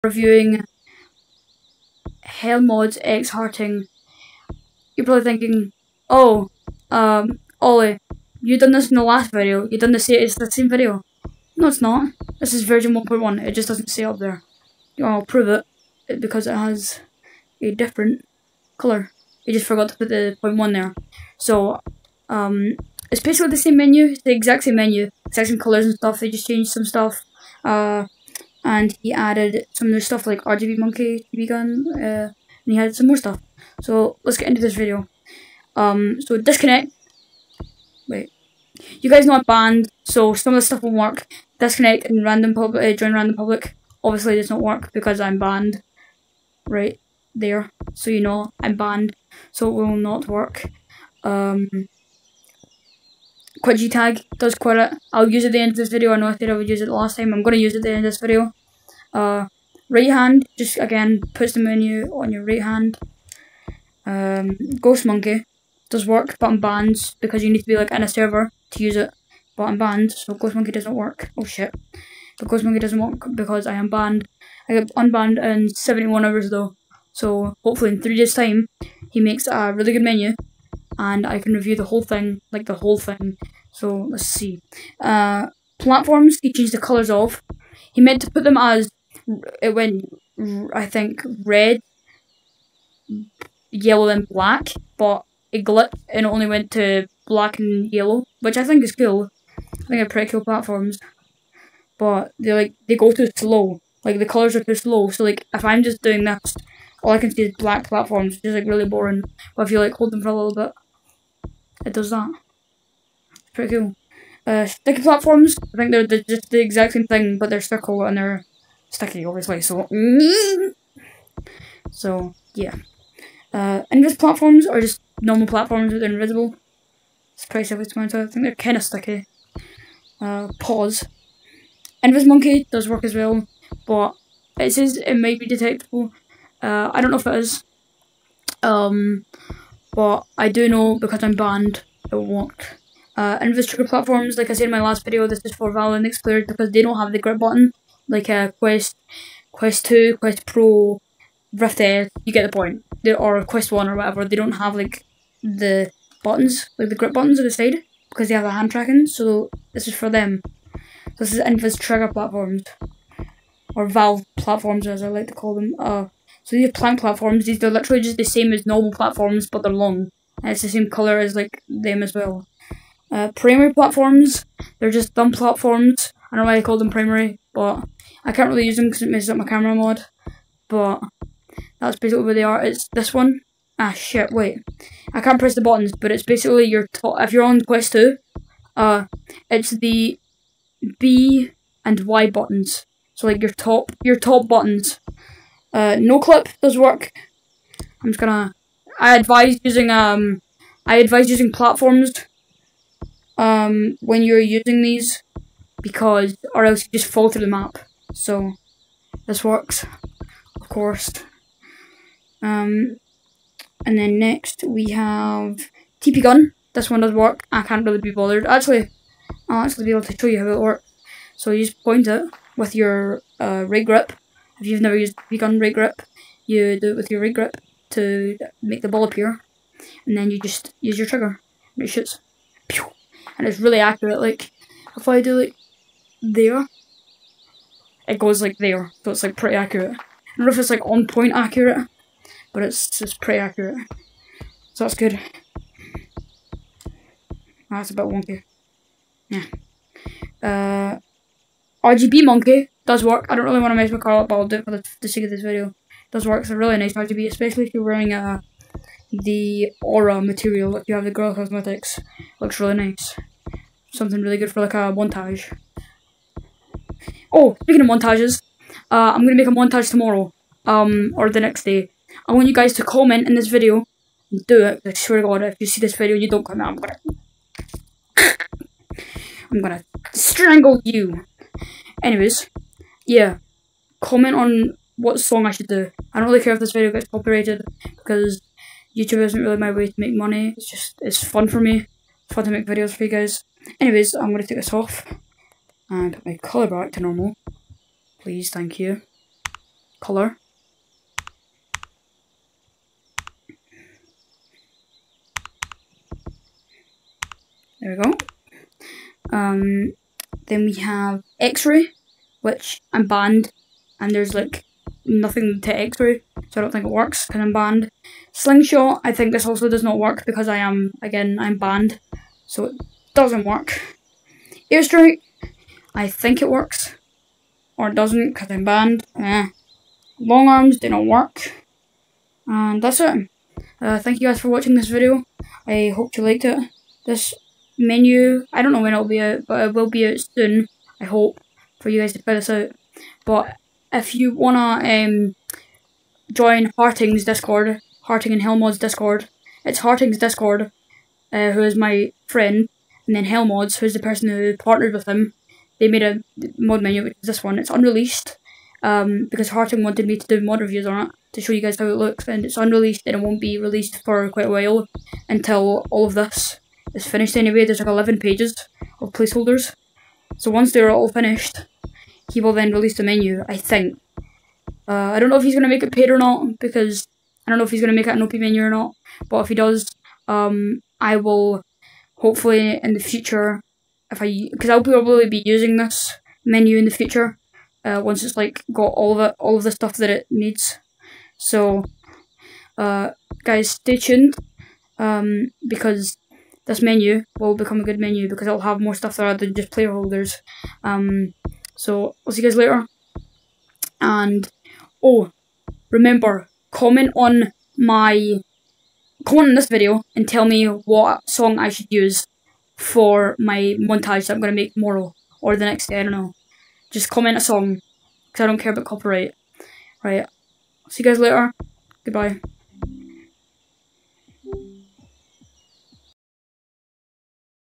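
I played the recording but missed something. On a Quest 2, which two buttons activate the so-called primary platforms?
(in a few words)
B and Y.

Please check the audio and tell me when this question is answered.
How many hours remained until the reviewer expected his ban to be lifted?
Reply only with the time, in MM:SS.
01:15.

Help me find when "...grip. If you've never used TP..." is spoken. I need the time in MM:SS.
03:43.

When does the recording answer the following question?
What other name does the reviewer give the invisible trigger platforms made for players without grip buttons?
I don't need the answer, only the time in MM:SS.
02:43.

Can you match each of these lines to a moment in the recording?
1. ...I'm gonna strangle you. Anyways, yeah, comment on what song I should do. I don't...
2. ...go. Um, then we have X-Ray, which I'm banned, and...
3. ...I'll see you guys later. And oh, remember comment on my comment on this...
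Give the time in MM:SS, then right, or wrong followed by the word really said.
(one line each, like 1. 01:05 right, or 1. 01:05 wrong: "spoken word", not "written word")
1. 04:39 right
2. 05:08 right
3. 06:42 right.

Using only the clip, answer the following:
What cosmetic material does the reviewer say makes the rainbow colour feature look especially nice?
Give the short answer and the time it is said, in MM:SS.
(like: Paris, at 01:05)
aura material, at 04:19.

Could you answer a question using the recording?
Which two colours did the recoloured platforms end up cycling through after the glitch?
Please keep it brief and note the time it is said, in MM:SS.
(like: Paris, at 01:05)
black and yellow, at 01:37.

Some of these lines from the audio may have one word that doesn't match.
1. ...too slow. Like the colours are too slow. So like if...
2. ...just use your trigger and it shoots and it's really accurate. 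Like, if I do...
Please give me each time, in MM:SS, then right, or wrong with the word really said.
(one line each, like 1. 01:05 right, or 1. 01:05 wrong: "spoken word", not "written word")
1. 01:43 right
2. 03:50 right.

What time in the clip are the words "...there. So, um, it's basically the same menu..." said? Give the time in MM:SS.
00:20.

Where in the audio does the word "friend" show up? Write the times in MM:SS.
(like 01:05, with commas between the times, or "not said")
05:52.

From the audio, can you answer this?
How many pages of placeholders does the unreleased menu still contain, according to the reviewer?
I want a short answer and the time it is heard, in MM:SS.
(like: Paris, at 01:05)
11, at 06:07.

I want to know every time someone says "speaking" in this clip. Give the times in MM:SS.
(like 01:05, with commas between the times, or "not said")
04:27.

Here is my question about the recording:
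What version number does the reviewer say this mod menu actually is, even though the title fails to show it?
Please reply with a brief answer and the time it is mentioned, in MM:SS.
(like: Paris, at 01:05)
1.1, at 00:12.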